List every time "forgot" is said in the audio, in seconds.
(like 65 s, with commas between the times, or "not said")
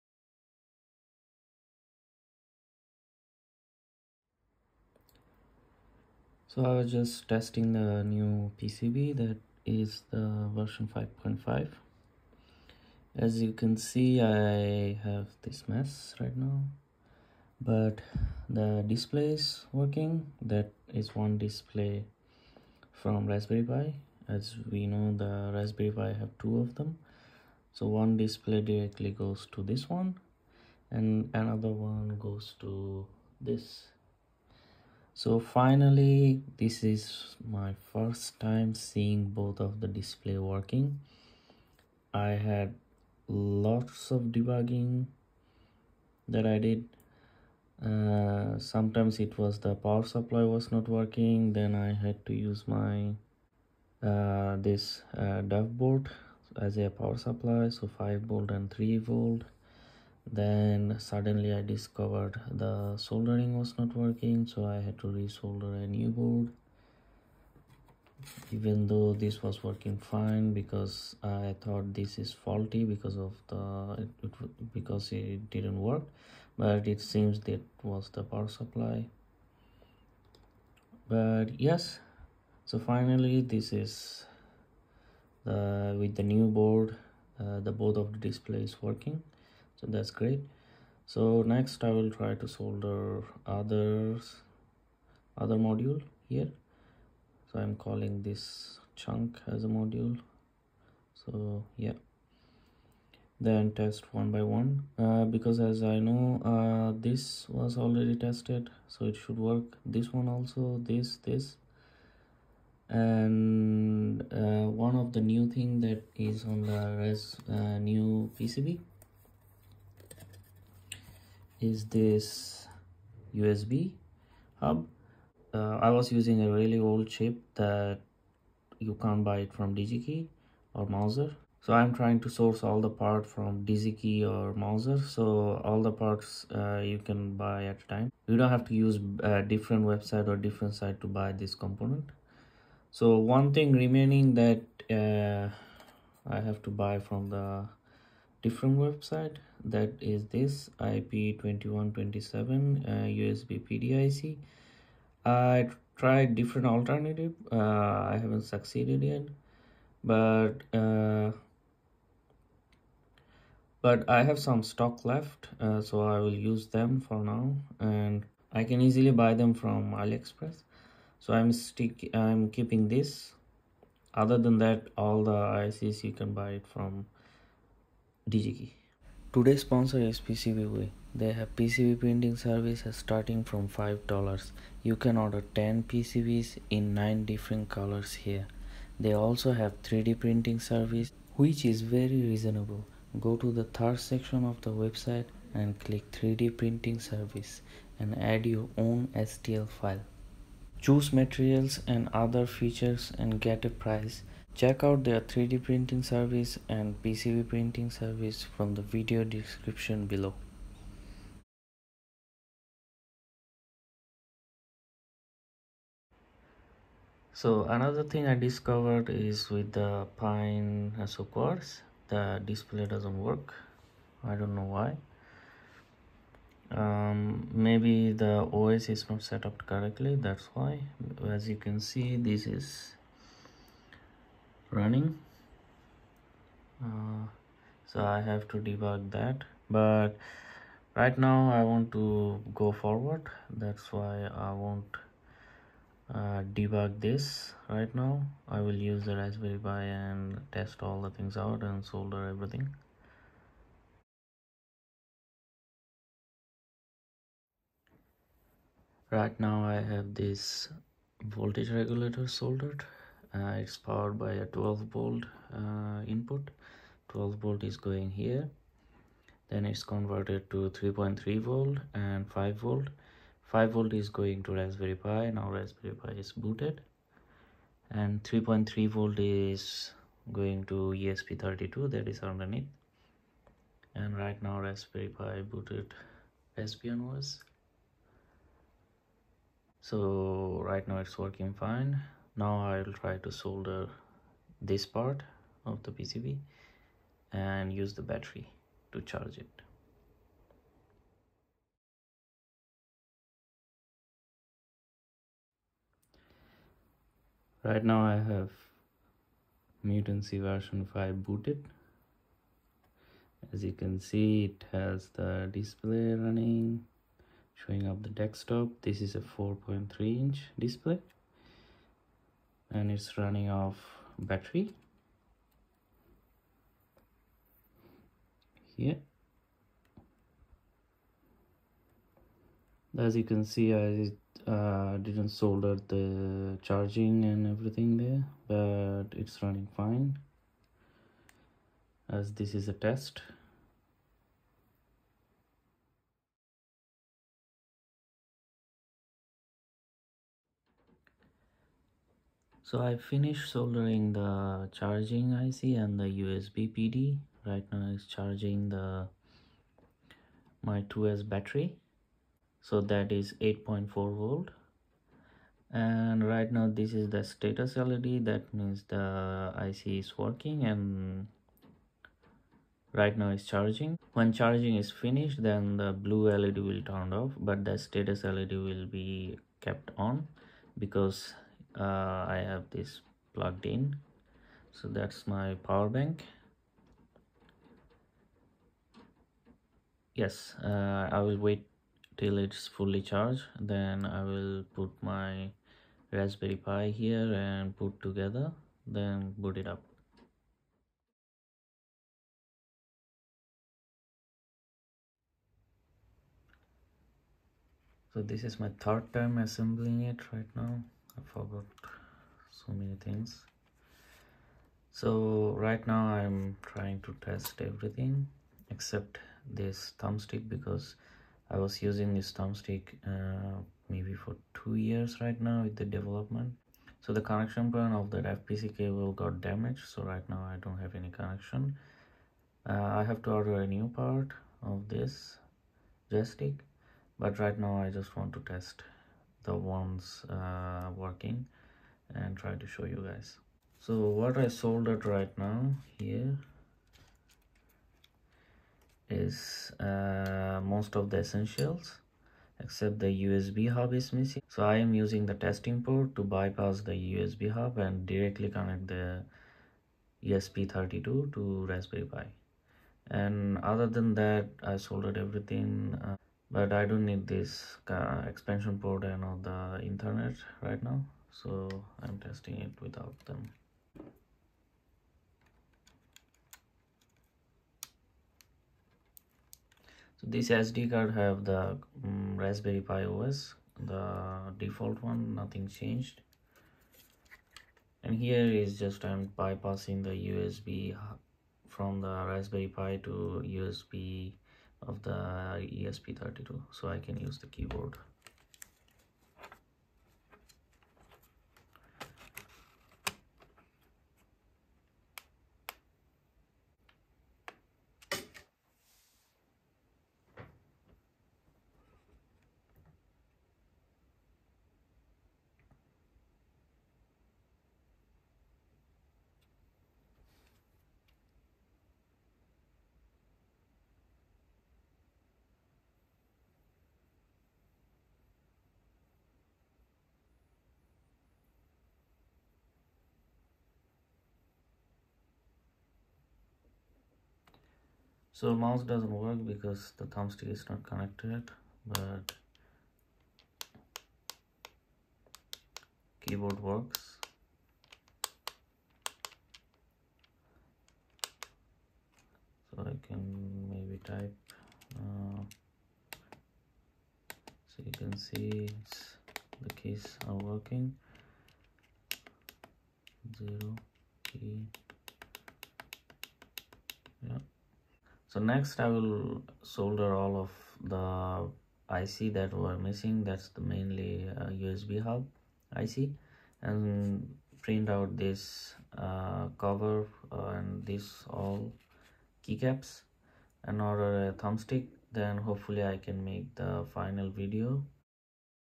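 411 s.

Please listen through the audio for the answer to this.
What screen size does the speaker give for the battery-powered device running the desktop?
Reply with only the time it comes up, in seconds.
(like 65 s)
319 s.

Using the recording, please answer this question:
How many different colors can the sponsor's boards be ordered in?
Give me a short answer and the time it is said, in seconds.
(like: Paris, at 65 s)
9, at 186 s.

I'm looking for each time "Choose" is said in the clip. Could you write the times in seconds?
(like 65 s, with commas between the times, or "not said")
200 s.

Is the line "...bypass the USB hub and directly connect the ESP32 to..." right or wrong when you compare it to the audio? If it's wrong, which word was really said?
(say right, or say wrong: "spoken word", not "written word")
right.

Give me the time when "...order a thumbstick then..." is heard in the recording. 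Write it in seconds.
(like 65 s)
583 s.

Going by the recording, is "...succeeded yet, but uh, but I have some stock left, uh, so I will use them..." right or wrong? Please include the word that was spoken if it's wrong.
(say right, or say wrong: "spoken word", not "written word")
right.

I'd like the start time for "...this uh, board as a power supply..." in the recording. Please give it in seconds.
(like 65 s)
54 s.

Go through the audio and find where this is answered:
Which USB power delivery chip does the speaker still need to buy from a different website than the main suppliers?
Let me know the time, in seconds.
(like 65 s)
150 s.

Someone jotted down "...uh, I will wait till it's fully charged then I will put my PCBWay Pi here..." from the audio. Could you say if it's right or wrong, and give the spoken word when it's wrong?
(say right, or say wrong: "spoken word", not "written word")
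wrong: "Raspberry", not "PCBWay".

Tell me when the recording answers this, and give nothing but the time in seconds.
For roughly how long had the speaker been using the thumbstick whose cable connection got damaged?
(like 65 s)
424 s.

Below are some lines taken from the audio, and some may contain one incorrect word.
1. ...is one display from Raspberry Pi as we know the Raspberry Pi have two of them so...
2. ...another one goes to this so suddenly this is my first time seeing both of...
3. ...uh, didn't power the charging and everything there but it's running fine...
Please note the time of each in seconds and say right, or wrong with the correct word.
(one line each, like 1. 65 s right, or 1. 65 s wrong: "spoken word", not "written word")
1. 20 s right
2. 31 s wrong: "finally", not "suddenly"
3. 334 s wrong: "solder", not "power".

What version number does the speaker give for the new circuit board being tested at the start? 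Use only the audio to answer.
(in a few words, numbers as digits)
5.5.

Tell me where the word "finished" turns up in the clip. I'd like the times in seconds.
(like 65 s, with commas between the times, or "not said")
353 s, 374 s.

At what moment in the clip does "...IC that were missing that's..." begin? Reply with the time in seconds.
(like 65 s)
571 s.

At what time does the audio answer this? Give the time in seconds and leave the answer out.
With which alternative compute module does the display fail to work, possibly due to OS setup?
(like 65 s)
220 s.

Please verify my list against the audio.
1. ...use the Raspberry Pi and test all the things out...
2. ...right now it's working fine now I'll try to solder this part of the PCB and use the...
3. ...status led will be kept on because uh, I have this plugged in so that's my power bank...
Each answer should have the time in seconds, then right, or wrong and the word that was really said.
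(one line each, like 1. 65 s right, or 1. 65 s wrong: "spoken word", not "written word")
1. 248 s right
2. 290 s right
3. 377 s right.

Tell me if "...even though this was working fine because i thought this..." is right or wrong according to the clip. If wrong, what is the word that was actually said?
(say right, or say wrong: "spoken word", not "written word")
right.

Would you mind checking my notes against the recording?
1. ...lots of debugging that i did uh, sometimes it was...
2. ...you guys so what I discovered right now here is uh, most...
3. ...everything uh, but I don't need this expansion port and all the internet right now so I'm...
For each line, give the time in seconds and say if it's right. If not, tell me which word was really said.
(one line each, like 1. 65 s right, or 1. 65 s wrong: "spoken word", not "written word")
1. 43 s right
2. 442 s wrong: "soldered", not "discovered"
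3. 465 s right.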